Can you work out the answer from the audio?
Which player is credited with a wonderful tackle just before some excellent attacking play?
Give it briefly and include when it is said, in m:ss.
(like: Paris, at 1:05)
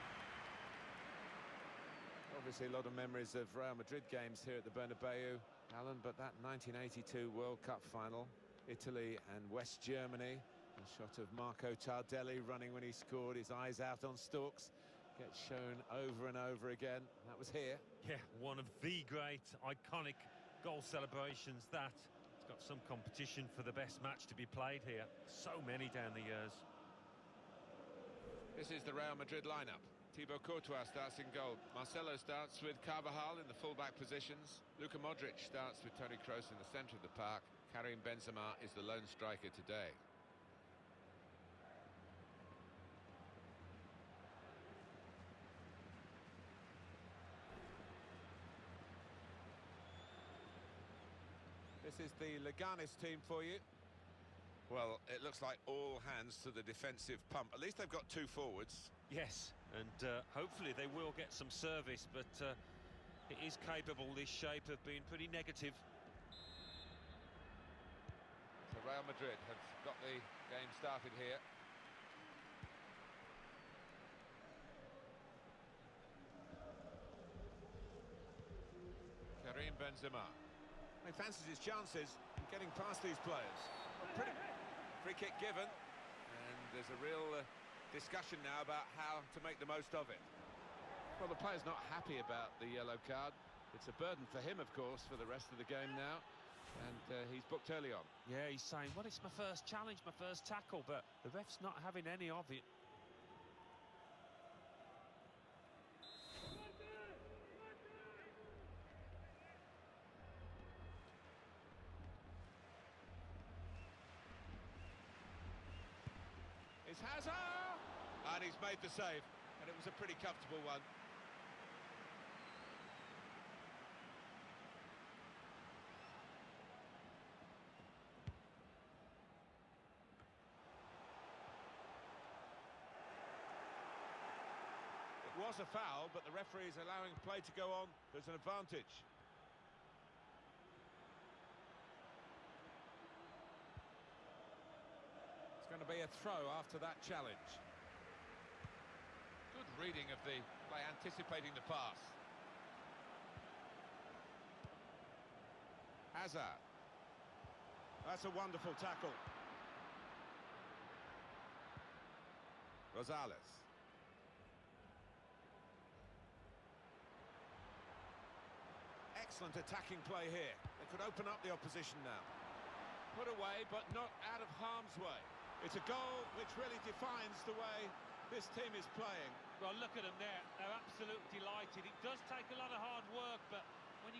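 Rosales, at 2:42.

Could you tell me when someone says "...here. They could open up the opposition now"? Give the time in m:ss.
2:50.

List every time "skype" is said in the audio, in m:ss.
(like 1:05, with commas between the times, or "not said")
not said.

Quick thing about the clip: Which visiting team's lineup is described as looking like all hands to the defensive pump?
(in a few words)
Leganes.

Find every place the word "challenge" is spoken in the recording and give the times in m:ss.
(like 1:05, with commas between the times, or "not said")
1:39, 2:27.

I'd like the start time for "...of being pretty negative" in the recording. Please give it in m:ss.
1:04.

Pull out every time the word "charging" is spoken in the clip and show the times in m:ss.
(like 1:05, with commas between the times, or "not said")
not said.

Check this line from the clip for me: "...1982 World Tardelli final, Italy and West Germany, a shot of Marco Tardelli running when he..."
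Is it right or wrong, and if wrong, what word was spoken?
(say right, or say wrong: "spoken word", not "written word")
wrong: "Cup", not "Tardelli".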